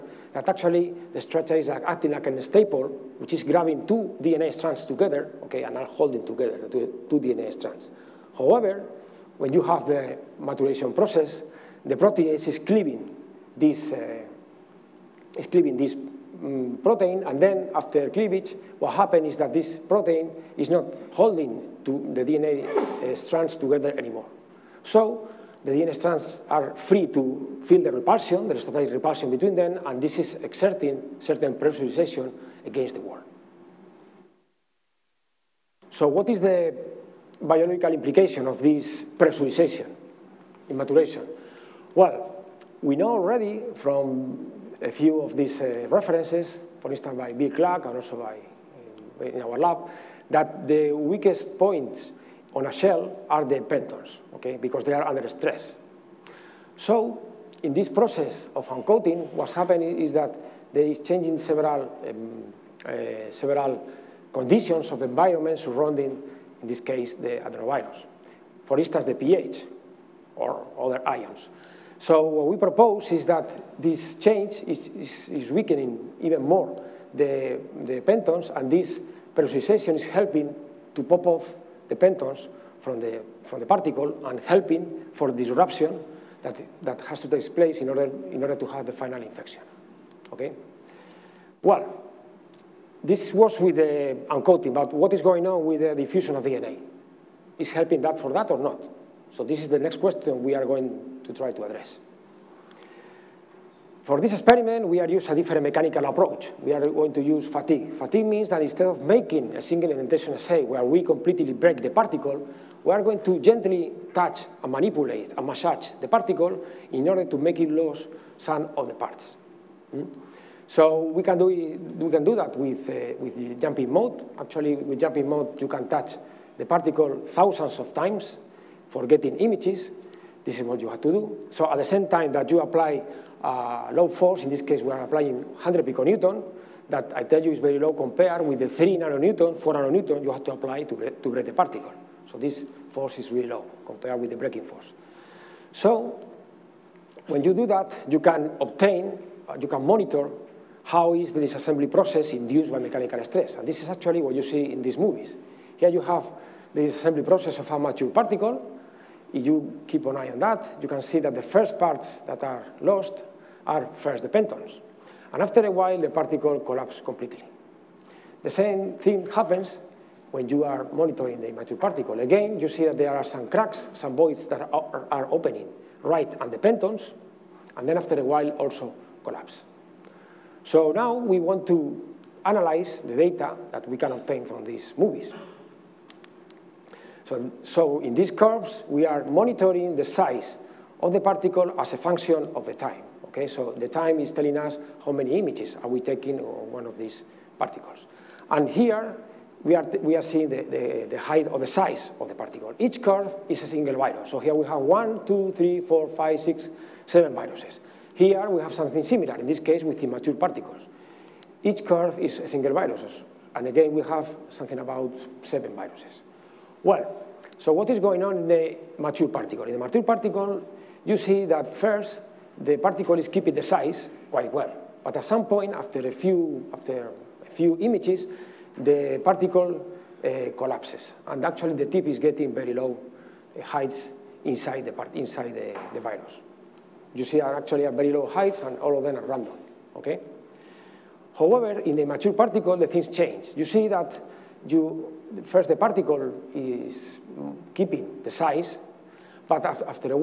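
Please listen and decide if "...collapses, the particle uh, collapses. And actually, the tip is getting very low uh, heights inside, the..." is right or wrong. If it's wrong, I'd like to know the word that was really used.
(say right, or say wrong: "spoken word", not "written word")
wrong: "images", not "collapses".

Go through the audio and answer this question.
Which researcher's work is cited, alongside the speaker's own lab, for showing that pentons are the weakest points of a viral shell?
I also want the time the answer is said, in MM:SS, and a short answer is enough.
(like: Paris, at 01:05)
Bill Clark, at 00:47.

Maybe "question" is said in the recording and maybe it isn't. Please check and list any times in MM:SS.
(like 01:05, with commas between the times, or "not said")
01:40.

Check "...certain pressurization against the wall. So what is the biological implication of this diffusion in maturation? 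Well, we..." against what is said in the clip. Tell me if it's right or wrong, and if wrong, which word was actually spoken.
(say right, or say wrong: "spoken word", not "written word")
wrong: "pressurization", not "diffusion".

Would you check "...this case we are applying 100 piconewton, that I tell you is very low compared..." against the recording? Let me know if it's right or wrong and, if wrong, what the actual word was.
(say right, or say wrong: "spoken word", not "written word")
right.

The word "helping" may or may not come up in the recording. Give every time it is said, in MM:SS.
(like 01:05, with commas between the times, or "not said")
01:20, 01:24, 01:37.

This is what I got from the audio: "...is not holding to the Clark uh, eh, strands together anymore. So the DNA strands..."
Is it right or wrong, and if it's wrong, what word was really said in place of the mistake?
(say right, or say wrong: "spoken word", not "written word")
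wrong: "DNA", not "Clark".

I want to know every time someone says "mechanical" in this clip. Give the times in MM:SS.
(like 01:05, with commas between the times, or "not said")
01:45, 02:32.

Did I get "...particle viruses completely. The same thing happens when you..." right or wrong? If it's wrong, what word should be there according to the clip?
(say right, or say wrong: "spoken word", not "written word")
wrong: "collapses", not "viruses".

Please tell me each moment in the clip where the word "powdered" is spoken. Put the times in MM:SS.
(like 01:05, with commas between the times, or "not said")
not said.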